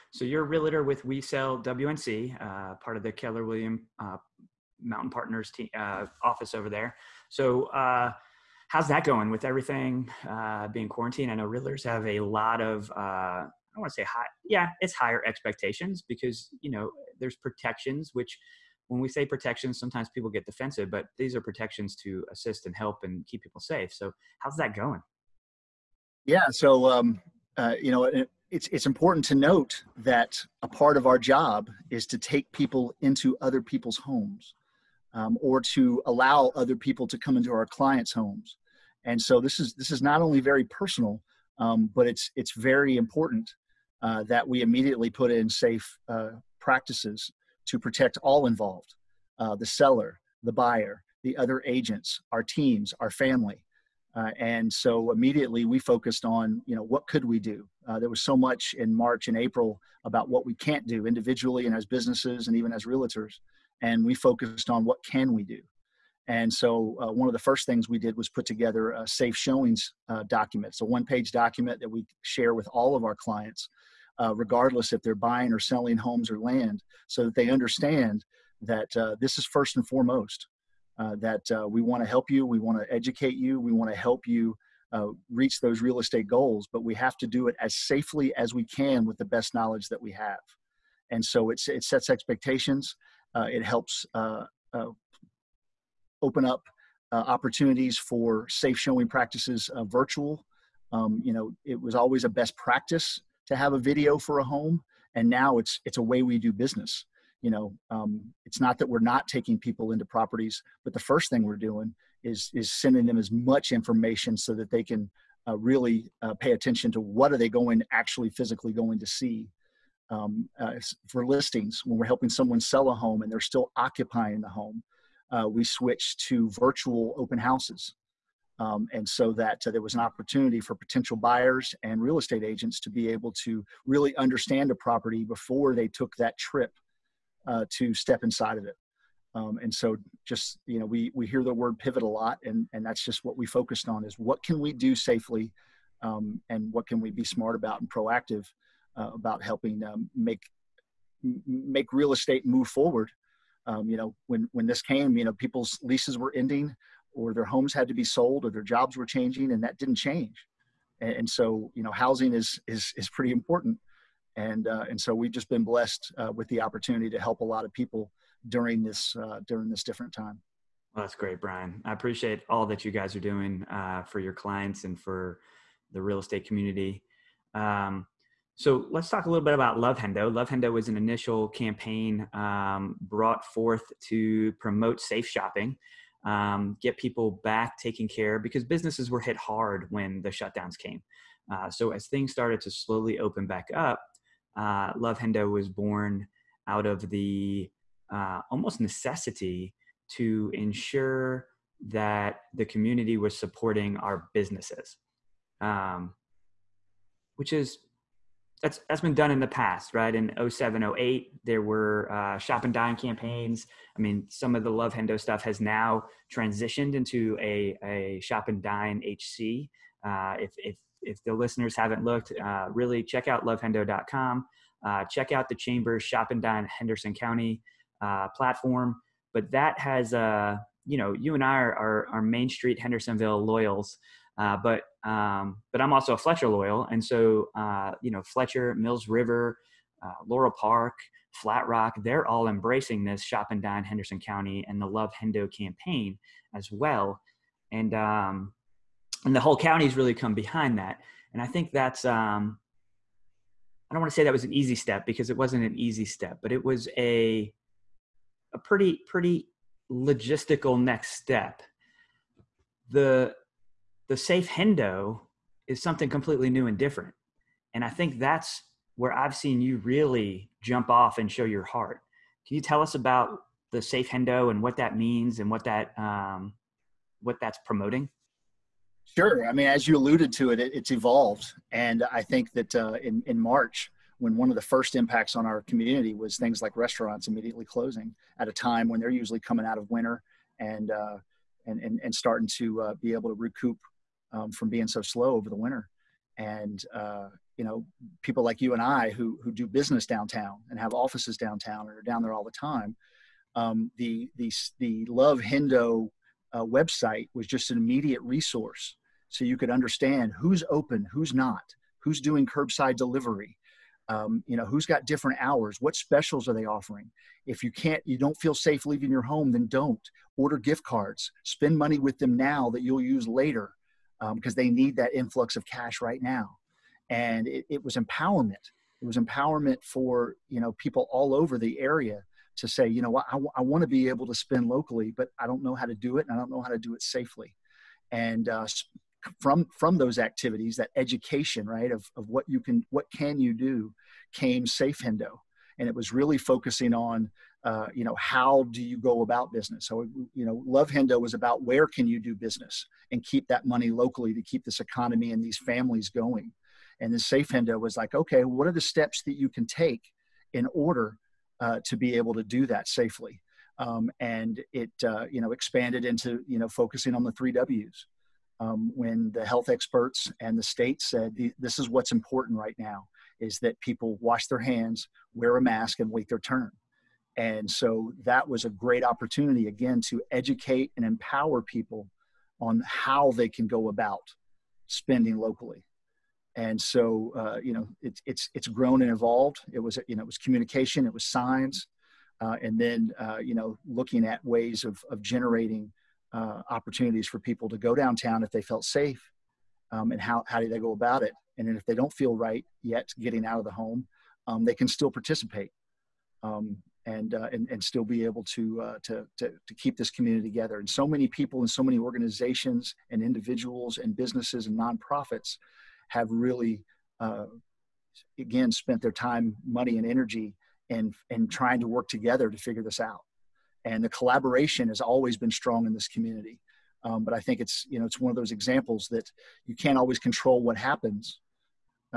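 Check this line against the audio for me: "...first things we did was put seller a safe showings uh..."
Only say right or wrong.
wrong.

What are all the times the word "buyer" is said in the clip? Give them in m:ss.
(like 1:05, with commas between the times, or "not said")
0:50, 2:11.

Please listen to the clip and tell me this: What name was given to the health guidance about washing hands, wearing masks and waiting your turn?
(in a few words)
the three W's.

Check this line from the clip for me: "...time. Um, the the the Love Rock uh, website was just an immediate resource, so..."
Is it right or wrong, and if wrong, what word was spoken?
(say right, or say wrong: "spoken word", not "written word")
wrong: "Hendo", not "Rock".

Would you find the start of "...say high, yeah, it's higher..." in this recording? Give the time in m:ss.
0:14.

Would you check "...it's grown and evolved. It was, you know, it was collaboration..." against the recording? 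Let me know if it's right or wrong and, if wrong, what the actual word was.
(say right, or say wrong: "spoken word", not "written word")
wrong: "communication", not "collaboration".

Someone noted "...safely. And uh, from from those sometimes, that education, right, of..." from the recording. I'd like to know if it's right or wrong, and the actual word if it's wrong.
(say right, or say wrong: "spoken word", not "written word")
wrong: "activities", not "sometimes".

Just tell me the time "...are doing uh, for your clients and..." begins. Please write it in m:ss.
2:53.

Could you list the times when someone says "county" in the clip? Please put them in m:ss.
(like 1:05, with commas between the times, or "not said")
3:47, 4:04, 4:09.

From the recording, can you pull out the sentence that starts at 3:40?
Uh, if, if, if the listeners haven't looked, uh, really check out lovehendo.com.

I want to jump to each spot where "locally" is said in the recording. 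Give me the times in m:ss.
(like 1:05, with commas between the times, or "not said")
5:34, 5:53, 6:25.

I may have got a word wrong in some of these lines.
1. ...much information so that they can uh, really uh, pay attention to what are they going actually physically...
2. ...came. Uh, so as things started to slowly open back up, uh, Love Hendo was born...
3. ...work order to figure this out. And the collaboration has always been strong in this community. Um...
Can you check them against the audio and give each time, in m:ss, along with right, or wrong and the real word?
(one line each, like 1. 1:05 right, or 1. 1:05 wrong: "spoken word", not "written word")
1. 1:53 right
2. 3:10 right
3. 7:01 wrong: "together", not "order".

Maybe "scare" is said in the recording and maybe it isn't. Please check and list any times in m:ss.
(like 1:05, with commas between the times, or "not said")
not said.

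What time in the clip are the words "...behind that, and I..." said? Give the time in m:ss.
4:10.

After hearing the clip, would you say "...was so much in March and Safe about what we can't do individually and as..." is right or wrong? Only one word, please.
wrong.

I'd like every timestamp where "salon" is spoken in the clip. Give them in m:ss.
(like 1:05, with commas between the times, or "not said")
not said.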